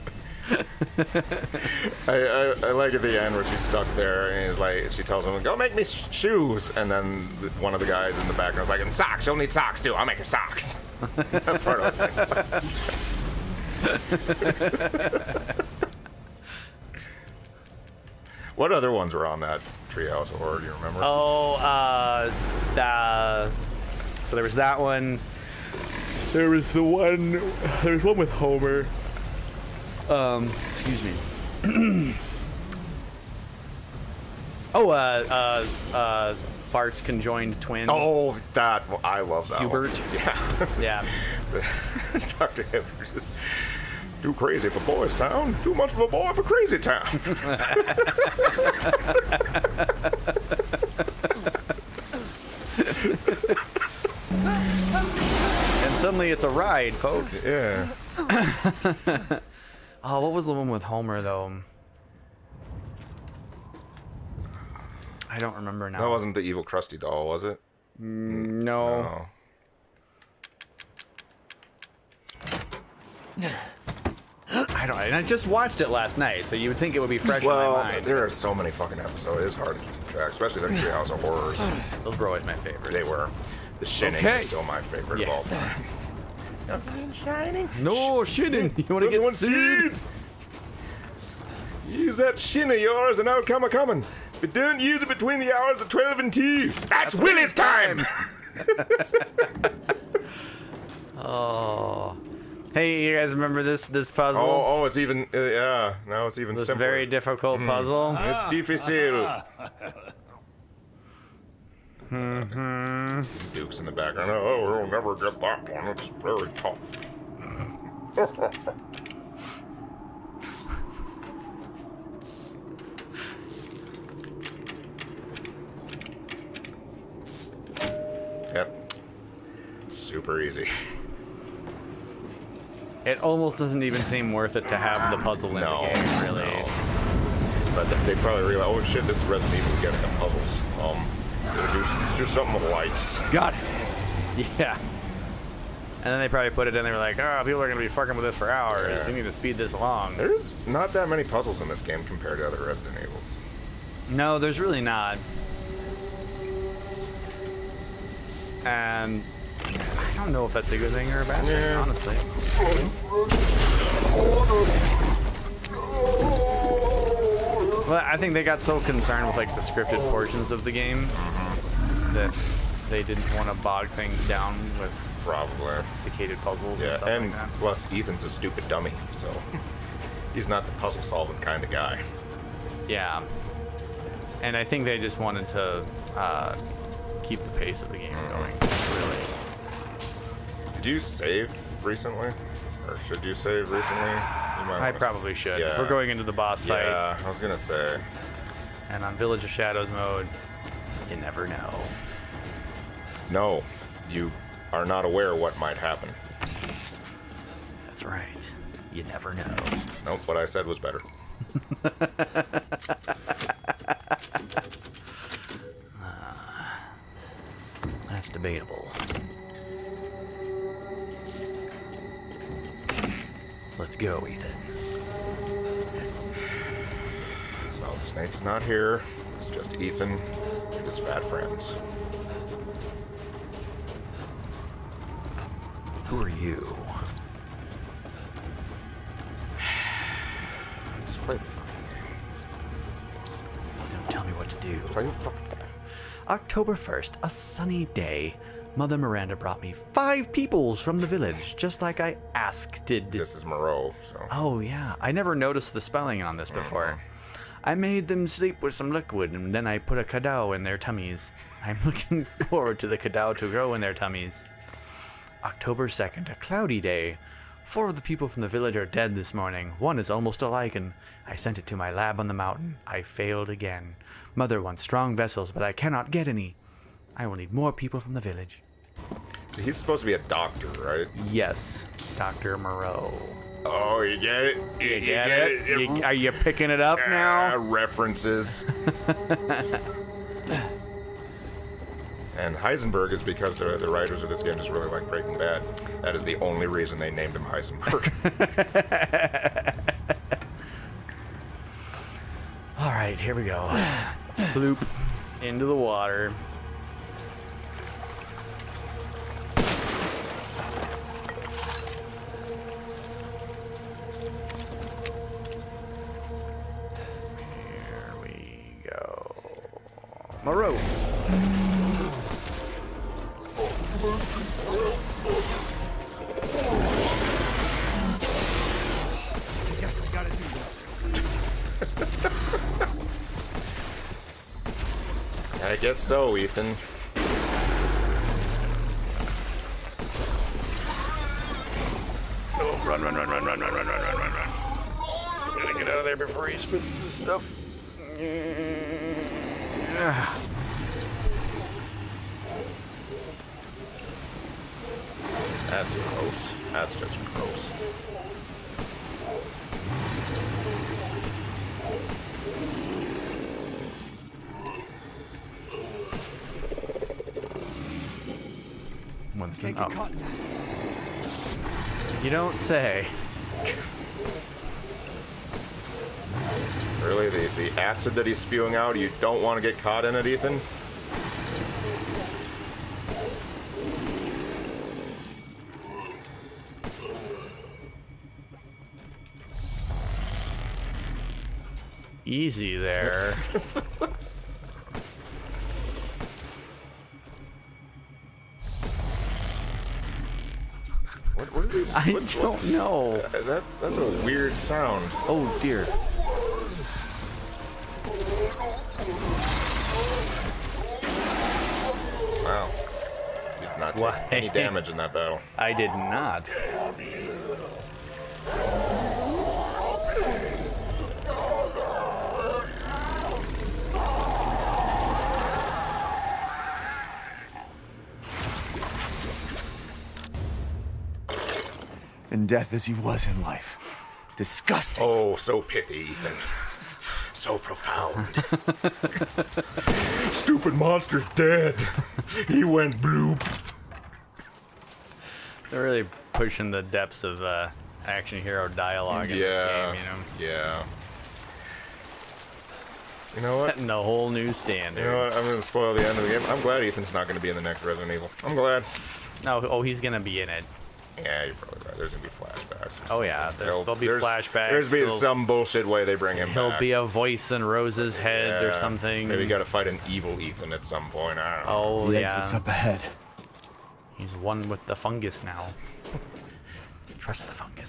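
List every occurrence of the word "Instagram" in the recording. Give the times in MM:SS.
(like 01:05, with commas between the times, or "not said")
not said.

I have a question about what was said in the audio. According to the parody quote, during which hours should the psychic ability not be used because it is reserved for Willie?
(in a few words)
12 and 2.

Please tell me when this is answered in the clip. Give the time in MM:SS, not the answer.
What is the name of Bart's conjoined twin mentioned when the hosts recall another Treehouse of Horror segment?
00:39.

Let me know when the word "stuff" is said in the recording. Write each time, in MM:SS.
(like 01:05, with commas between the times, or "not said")
02:56, 05:47.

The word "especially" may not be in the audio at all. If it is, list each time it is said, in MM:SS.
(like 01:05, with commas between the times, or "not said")
01:20.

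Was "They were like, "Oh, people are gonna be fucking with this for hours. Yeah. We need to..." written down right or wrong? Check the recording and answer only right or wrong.
right.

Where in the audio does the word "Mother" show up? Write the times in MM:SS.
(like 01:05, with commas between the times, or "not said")
04:08, 04:34.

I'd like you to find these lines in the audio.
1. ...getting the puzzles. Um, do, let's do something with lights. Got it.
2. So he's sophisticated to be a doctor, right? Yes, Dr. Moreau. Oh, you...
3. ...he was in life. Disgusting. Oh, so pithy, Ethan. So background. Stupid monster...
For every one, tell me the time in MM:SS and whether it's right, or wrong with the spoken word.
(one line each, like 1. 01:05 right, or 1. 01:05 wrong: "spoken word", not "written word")
1. 02:19 right
2. 04:39 wrong: "supposed", not "sophisticated"
3. 07:12 wrong: "profound", not "background".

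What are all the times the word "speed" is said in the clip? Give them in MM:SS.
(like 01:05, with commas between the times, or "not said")
02:29.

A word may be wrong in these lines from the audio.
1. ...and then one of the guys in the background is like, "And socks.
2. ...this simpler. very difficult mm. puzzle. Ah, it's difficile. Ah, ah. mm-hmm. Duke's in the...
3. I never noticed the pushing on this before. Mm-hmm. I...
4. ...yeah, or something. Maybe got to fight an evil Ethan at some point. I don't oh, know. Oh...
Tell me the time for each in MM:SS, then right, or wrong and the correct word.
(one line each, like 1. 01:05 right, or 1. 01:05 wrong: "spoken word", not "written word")
1. 00:06 right
2. 01:46 right
3. 04:14 wrong: "spelling", not "pushing"
4. 07:48 right.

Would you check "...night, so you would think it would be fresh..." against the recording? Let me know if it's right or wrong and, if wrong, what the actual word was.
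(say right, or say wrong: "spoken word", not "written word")
right.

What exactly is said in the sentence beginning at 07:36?
I'm glad Ethan's not going to be in the next Resident Evil.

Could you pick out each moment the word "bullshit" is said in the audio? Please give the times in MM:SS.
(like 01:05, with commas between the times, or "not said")
07:45.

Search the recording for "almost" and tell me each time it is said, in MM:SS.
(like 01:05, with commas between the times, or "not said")
02:13, 04:30.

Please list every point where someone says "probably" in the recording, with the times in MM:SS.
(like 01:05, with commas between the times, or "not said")
02:18, 02:26, 02:55, 03:14, 07:41.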